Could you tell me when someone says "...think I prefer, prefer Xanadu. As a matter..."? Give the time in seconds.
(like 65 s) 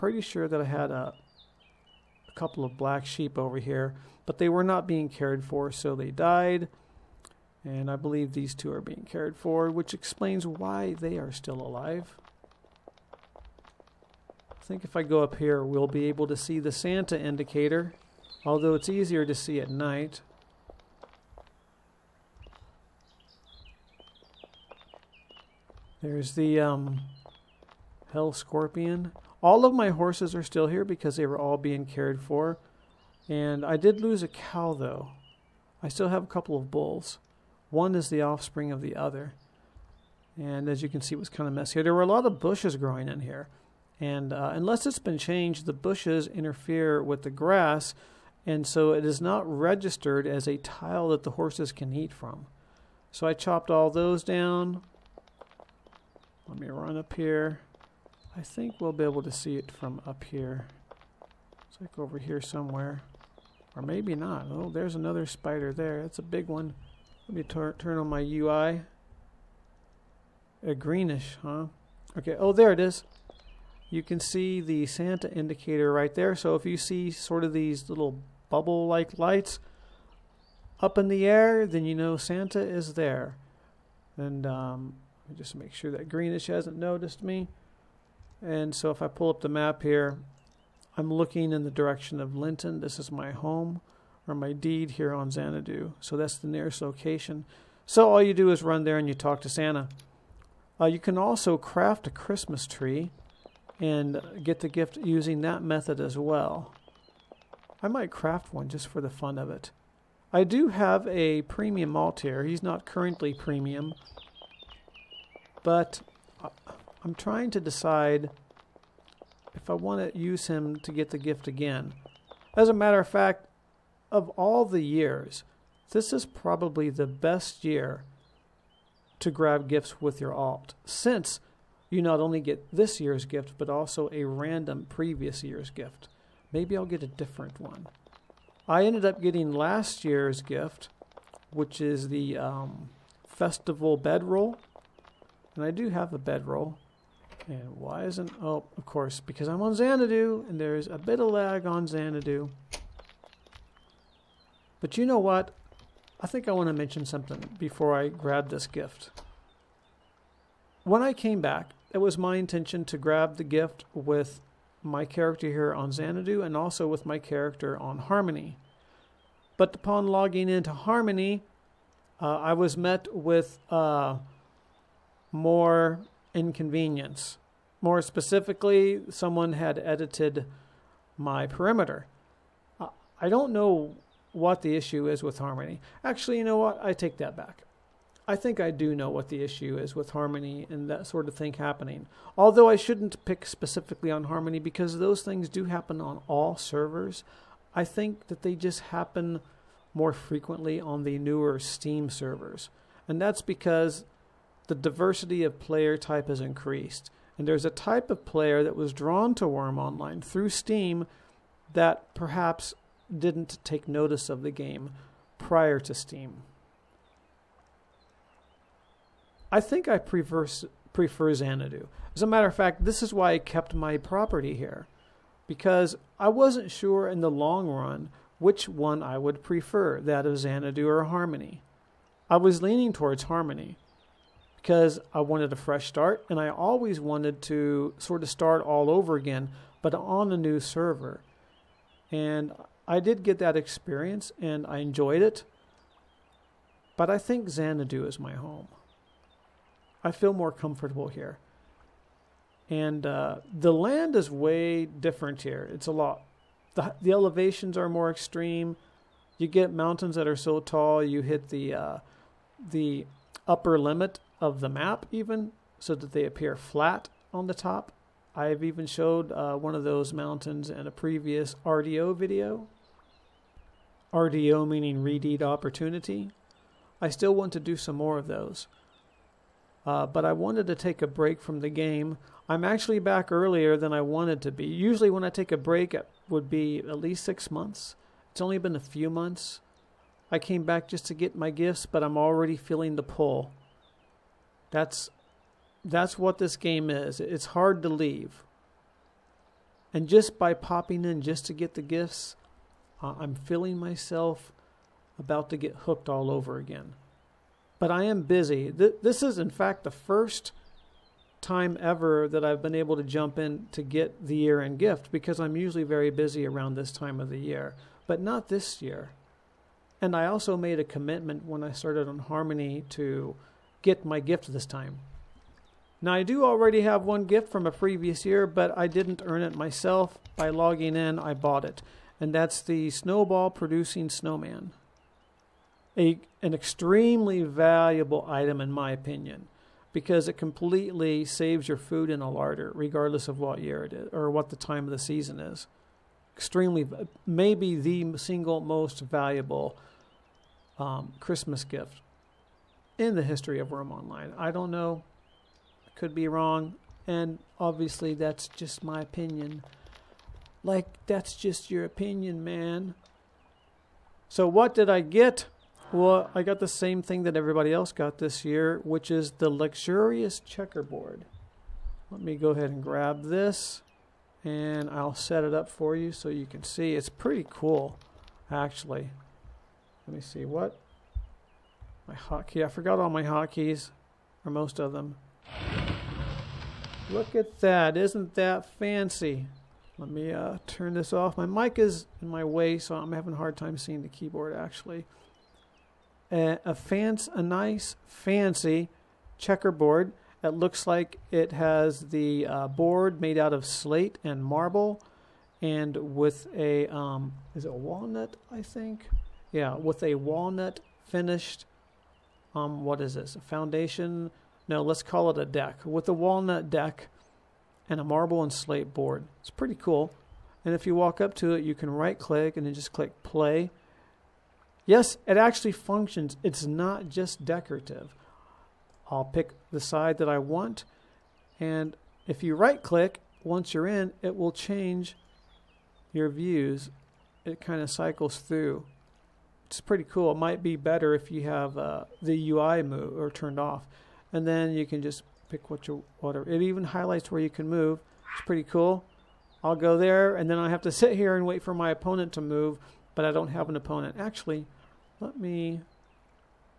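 219 s.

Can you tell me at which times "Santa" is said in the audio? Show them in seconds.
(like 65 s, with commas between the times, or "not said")
16 s, 74 s, 82 s, 99 s.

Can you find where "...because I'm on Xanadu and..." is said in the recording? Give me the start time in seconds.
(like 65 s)
149 s.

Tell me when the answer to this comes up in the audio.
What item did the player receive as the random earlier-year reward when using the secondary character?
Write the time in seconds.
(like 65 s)
143 s.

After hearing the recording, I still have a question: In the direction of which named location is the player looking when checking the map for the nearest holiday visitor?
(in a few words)
Linton.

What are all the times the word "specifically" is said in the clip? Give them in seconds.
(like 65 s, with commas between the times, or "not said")
178 s, 193 s.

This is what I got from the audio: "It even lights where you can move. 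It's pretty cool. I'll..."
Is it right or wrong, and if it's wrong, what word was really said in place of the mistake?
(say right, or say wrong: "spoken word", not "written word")
wrong: "highlights", not "lights".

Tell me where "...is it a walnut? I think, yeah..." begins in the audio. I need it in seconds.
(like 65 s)
407 s.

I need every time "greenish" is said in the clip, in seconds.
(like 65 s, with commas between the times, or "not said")
70 s, 86 s.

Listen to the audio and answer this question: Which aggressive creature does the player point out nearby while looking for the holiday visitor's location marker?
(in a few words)
Hell Scorpion.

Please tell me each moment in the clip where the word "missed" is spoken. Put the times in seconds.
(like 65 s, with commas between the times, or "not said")
not said.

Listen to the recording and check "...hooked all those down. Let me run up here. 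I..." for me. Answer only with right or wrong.
wrong.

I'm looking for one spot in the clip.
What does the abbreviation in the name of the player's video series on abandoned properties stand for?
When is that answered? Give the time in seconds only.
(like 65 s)
275 s.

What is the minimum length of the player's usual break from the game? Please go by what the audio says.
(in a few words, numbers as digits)
6 months.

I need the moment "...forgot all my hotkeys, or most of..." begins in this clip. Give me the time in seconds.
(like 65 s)
382 s.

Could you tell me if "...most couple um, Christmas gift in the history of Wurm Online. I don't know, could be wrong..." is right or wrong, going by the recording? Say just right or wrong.
wrong.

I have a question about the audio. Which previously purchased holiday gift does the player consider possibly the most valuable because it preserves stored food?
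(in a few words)
snowball producing snowman.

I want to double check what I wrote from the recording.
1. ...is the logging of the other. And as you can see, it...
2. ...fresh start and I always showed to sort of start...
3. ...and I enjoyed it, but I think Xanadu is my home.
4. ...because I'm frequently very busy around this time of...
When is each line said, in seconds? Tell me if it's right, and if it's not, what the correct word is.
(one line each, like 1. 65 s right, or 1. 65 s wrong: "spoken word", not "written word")
1. 37 s wrong: "offspring", not "logging"
2. 235 s wrong: "wanted", not "showed"
3. 244 s right
4. 315 s wrong: "usually", not "frequently".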